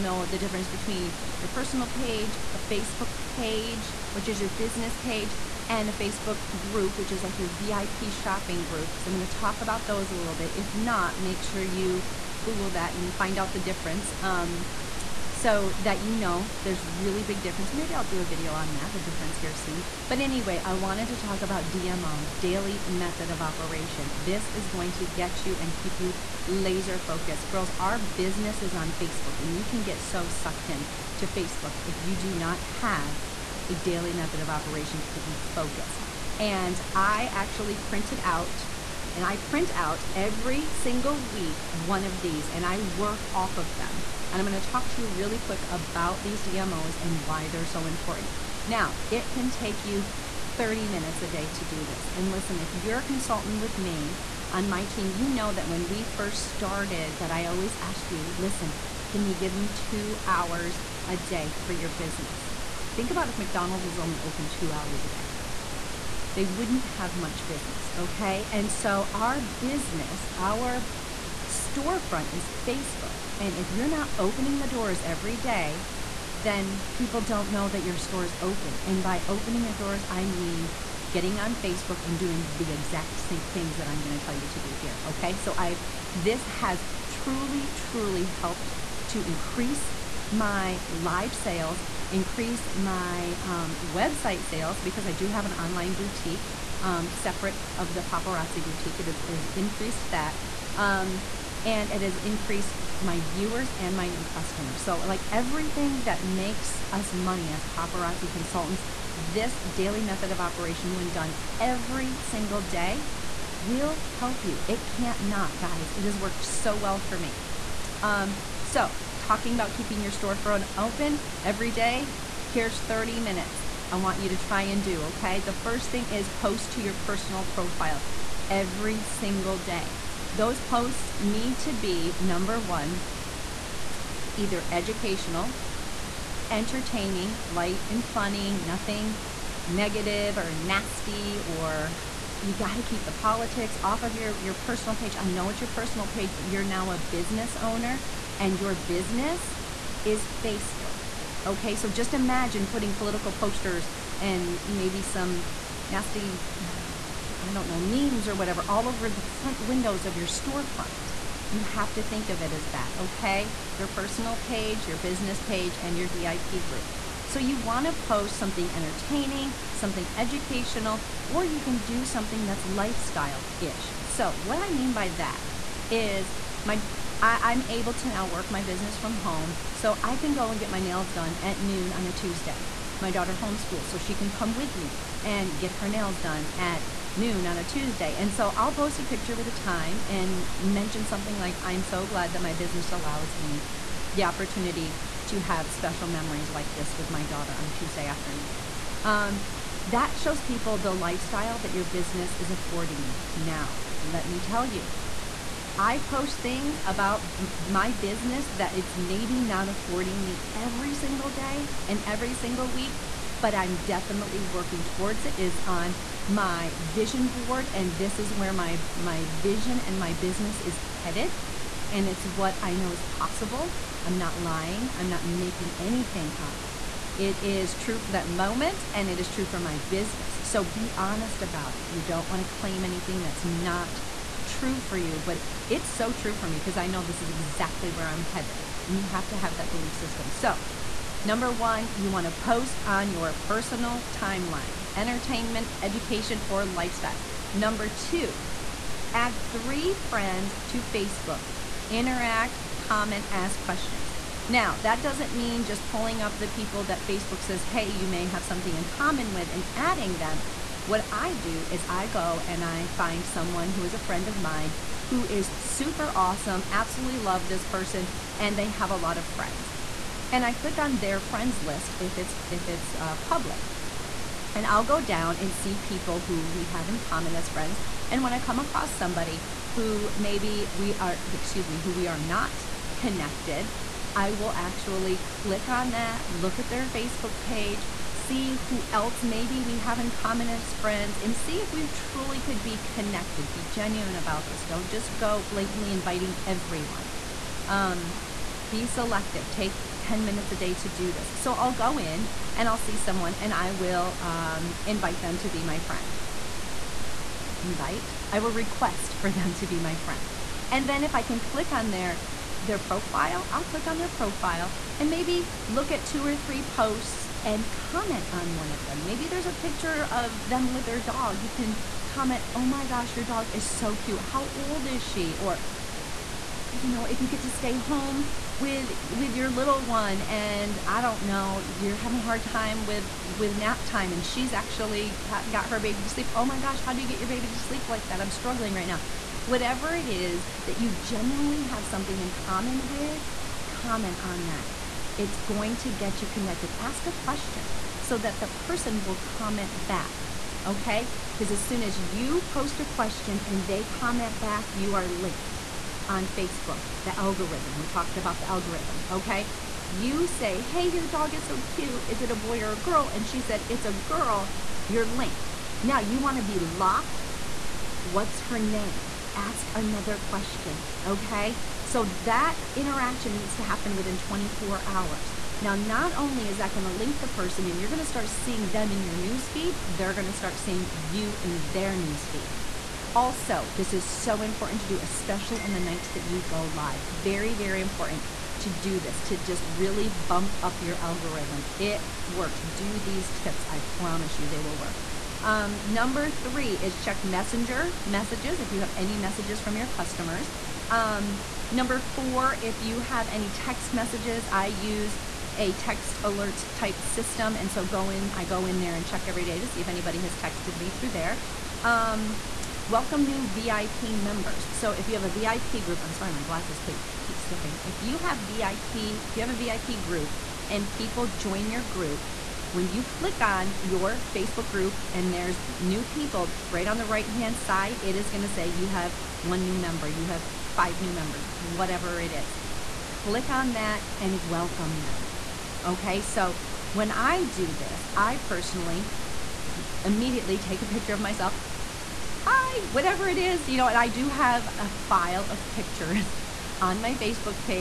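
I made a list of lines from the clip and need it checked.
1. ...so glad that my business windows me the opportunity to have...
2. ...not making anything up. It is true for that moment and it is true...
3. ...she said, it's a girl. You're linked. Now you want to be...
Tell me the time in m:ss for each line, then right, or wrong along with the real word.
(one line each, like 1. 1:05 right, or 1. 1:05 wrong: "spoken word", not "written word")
1. 3:11 wrong: "allows", not "windows"
2. 3:45 right
3. 6:03 right.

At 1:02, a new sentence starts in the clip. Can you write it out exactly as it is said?
Think about if McDonald's was only open two hours a day they wouldn't have much business, okay?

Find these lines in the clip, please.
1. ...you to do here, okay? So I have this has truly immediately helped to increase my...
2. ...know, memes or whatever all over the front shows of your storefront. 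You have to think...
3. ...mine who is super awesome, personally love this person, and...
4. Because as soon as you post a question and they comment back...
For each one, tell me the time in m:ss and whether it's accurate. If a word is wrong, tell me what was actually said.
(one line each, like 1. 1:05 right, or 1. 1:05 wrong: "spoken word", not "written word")
1. 1:24 wrong: "truly", not "immediately"
2. 2:37 wrong: "windows", not "shows"
3. 4:24 wrong: "absolutely", not "personally"
4. 5:51 right.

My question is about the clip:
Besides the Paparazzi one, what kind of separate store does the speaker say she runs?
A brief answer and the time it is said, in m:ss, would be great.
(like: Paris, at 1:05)
online boutique, at 1:35.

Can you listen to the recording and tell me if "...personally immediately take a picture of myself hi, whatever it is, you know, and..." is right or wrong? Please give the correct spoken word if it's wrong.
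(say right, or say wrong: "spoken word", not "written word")
right.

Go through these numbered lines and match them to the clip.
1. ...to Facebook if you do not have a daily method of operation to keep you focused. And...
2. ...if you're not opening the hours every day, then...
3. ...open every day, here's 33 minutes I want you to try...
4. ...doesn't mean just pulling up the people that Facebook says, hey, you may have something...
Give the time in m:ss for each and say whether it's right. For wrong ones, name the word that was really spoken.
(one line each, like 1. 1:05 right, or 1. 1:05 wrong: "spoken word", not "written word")
1. 0:31 right
2. 1:13 wrong: "doors", not "hours"
3. 2:00 wrong: "30", not "33"
4. 4:15 right.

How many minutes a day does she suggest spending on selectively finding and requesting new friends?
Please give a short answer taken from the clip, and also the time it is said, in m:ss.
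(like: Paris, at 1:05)
10, at 4:59.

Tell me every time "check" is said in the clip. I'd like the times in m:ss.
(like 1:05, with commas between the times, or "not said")
6:37, 6:49.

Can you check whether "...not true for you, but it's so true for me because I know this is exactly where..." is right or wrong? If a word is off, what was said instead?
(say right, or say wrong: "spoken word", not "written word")
right.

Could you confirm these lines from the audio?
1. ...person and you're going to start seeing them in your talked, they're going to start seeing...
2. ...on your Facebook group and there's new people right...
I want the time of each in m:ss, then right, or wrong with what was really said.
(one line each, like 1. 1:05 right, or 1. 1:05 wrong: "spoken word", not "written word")
1. 6:17 wrong: "newsfeed", not "talked"
2. 7:03 right.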